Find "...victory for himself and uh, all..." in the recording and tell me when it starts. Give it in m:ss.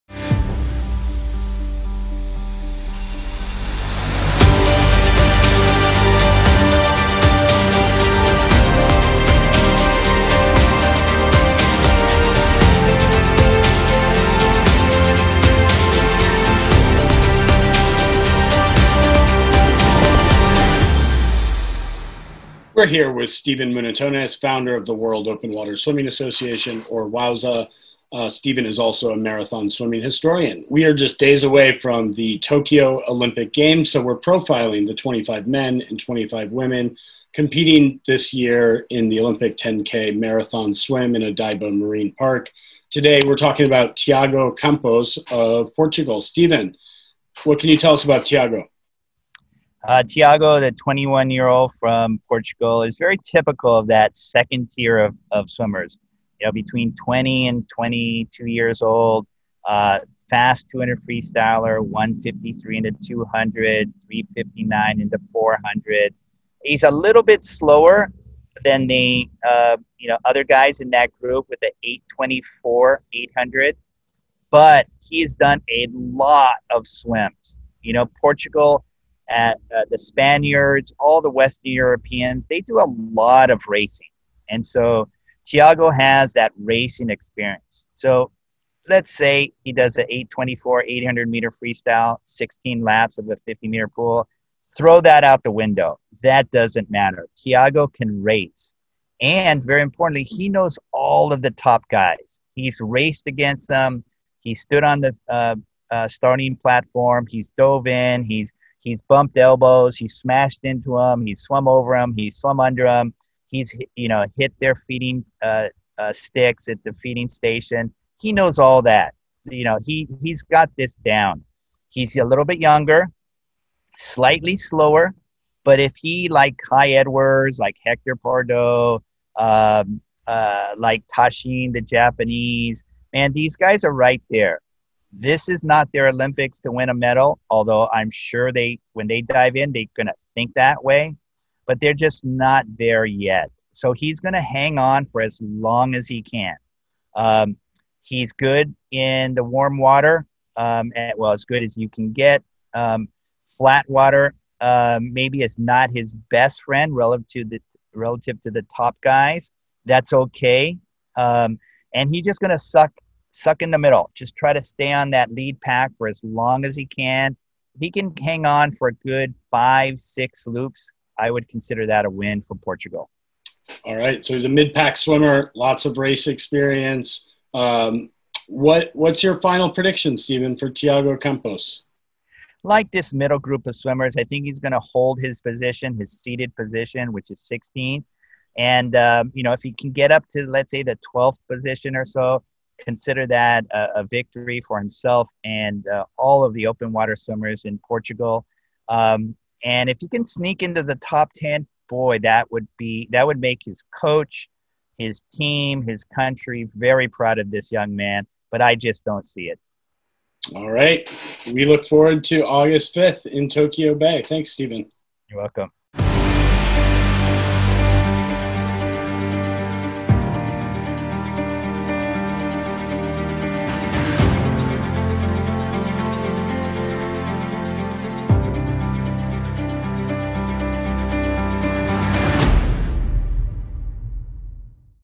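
3:14.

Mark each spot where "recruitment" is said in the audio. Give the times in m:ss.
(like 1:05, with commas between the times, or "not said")
not said.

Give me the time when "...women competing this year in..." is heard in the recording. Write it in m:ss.
0:36.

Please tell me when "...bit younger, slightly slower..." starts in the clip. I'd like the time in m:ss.
2:02.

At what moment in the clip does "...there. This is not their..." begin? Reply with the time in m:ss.
2:14.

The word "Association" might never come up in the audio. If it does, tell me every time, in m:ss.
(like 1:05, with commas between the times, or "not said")
0:26.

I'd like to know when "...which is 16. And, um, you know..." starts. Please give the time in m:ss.
3:07.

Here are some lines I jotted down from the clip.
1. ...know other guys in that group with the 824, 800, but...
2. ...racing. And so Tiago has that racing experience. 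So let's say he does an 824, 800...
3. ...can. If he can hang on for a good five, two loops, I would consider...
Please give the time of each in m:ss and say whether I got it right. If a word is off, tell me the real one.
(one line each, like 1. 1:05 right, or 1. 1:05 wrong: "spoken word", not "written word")
1. 1:10 right
2. 1:23 right
3. 2:46 wrong: "six", not "two".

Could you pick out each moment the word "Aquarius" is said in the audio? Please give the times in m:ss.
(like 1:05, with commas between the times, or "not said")
not said.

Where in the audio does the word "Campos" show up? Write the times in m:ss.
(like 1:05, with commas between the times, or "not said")
0:44, 3:01.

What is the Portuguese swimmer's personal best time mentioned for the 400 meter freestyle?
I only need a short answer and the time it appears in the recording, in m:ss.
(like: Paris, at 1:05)
3:59, at 1:04.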